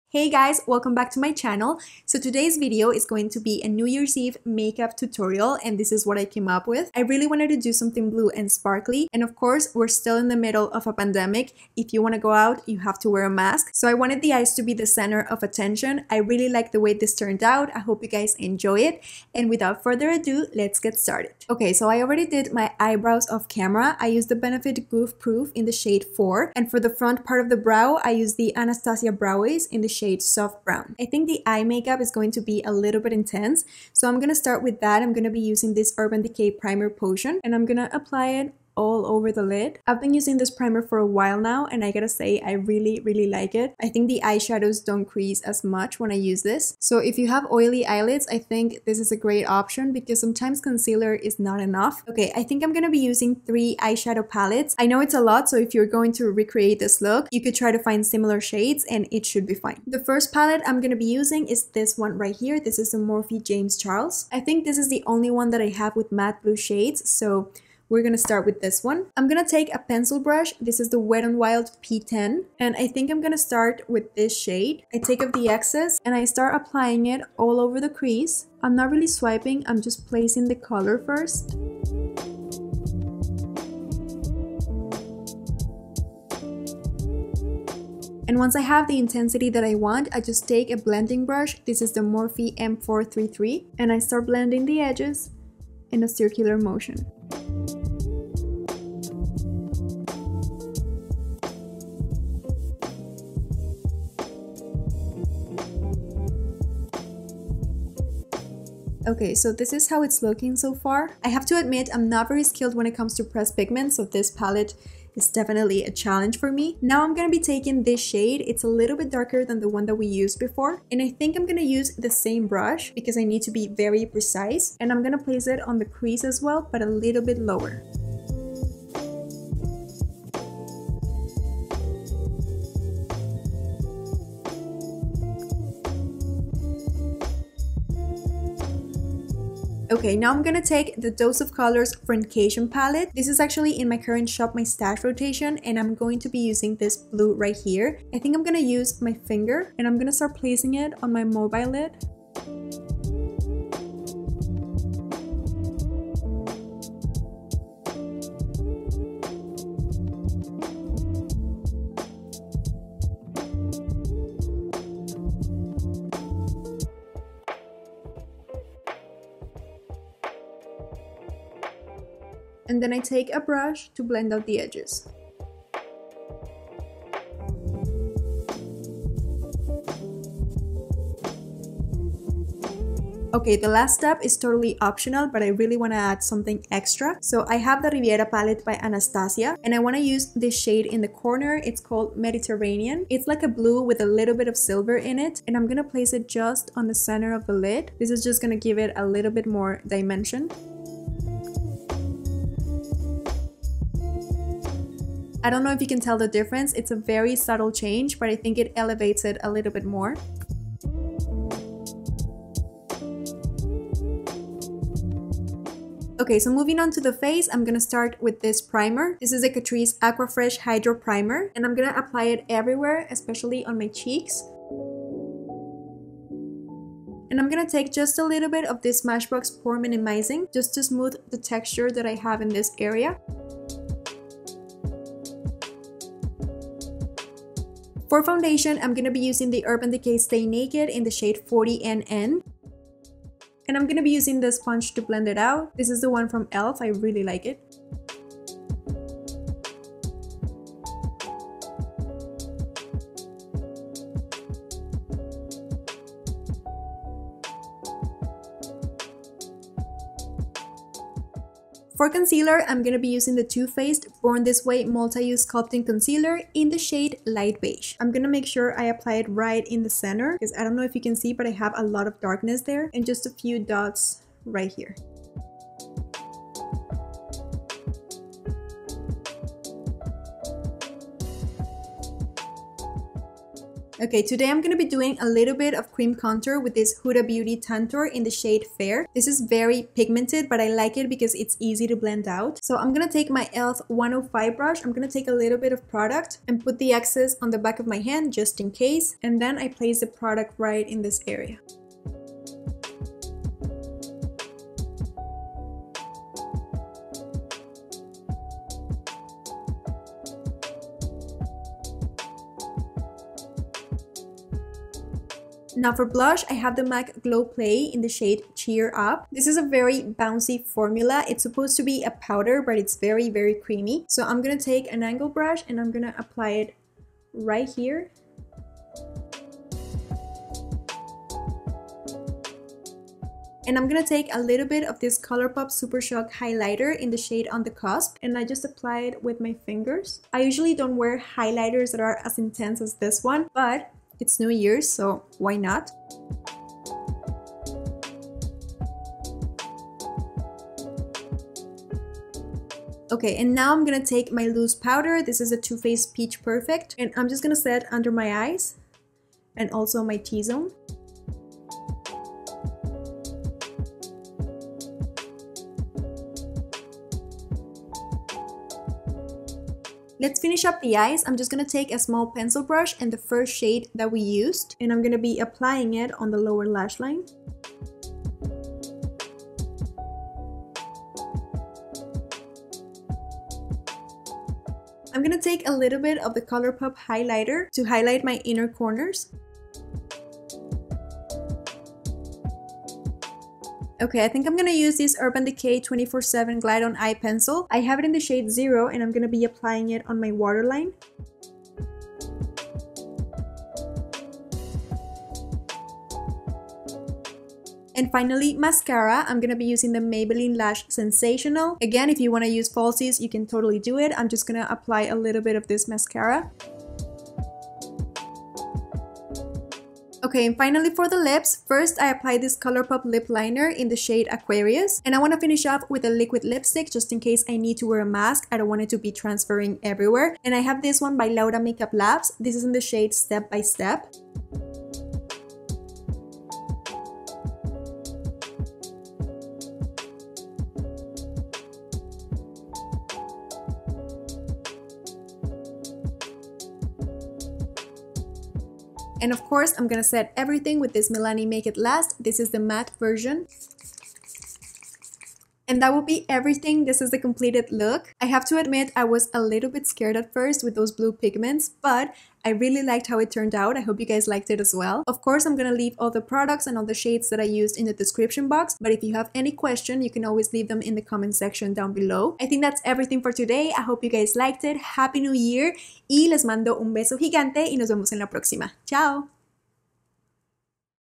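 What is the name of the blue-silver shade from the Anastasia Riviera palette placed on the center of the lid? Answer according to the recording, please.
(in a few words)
Mediterranean.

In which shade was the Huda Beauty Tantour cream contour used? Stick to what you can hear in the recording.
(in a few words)
Fair.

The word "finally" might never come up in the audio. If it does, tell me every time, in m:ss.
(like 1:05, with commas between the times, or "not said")
6:48, 7:00.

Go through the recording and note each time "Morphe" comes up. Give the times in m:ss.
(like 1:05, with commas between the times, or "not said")
1:02, 1:31.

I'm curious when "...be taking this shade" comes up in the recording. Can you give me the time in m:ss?
1:57.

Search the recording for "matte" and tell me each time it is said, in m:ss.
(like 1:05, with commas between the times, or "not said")
1:06, 7:32.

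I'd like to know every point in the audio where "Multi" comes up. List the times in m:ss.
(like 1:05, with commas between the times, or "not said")
4:24.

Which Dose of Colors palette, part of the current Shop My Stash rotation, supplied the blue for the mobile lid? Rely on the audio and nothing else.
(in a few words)
Friendcation.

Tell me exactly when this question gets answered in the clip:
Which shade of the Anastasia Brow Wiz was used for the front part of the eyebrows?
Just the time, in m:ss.
0:30.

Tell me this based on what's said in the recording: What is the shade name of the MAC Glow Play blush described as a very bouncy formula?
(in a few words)
Cheer Up.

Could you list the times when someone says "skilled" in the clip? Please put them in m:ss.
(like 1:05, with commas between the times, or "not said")
1:52.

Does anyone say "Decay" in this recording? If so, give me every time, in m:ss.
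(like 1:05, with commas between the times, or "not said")
0:36, 3:59, 6:35.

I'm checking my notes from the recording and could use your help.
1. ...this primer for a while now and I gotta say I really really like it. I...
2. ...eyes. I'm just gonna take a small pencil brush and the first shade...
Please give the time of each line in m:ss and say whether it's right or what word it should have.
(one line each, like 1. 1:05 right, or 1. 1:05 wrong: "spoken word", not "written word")
1. 0:40 right
2. 6:10 right.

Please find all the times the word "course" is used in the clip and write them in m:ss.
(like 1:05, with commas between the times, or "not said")
0:09, 7:29, 7:45.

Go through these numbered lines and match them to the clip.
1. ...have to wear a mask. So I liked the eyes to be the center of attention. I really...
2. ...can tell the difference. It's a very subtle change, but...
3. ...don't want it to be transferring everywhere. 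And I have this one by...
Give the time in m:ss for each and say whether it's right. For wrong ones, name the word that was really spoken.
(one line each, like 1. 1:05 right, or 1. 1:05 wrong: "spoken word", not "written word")
1. 0:12 wrong: "wanted", not "liked"
2. 3:25 right
3. 7:08 right.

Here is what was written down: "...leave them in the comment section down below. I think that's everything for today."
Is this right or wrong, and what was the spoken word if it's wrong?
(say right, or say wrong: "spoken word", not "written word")
right.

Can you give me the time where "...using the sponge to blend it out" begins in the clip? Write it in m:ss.
4:04.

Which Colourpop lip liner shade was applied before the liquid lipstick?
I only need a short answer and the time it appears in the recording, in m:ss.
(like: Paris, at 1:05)
Aquarius, at 7:04.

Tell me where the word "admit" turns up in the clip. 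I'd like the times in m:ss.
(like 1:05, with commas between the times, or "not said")
1:51, 7:38.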